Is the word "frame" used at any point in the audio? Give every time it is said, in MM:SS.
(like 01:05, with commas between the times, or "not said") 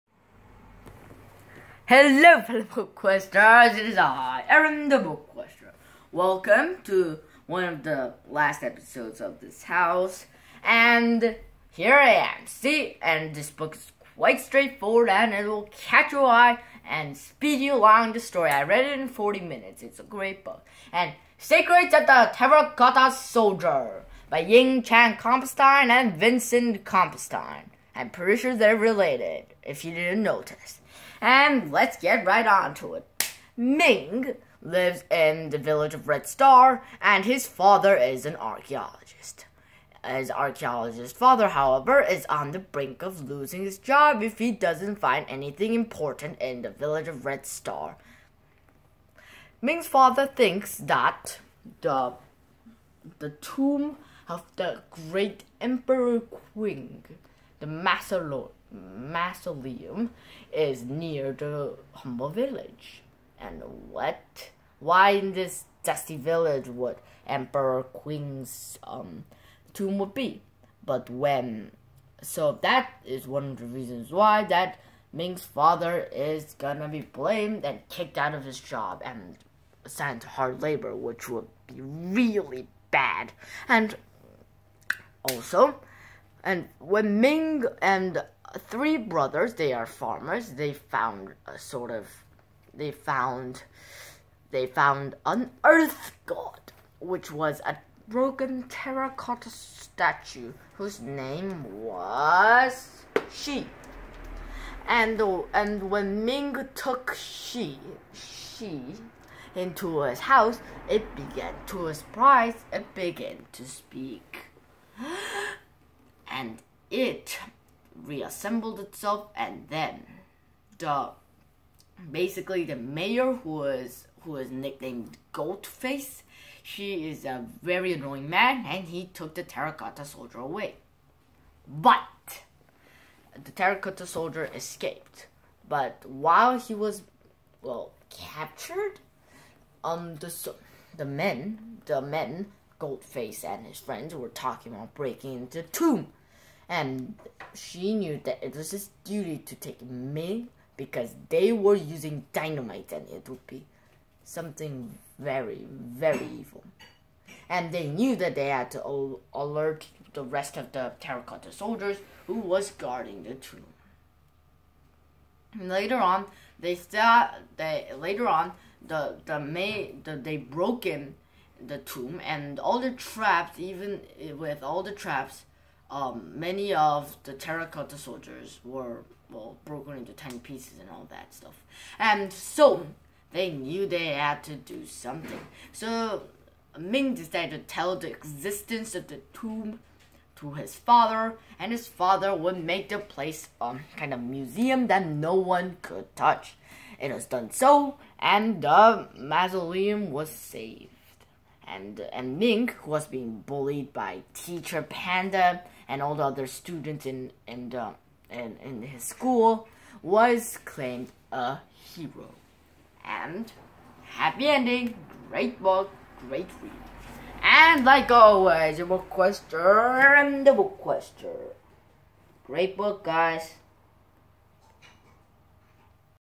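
not said.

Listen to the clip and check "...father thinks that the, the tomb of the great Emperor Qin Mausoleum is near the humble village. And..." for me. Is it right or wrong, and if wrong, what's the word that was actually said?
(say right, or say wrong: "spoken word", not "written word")
right.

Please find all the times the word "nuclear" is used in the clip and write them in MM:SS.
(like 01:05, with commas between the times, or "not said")
not said.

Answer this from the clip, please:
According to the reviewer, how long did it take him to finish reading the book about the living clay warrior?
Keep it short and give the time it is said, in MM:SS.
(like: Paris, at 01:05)
40 minutes, at 00:19.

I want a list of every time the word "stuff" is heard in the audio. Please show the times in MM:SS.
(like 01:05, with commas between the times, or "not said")
03:01.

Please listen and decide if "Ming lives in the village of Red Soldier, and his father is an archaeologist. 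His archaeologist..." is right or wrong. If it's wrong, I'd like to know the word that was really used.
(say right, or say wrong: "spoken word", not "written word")
wrong: "Star", not "Soldier".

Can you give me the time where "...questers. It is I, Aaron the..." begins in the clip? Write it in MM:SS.
00:02.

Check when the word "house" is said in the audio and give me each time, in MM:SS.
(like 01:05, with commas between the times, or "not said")
00:09, 01:50.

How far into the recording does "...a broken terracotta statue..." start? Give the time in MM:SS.
01:37.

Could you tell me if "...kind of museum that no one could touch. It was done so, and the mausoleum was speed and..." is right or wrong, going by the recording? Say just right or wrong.
wrong.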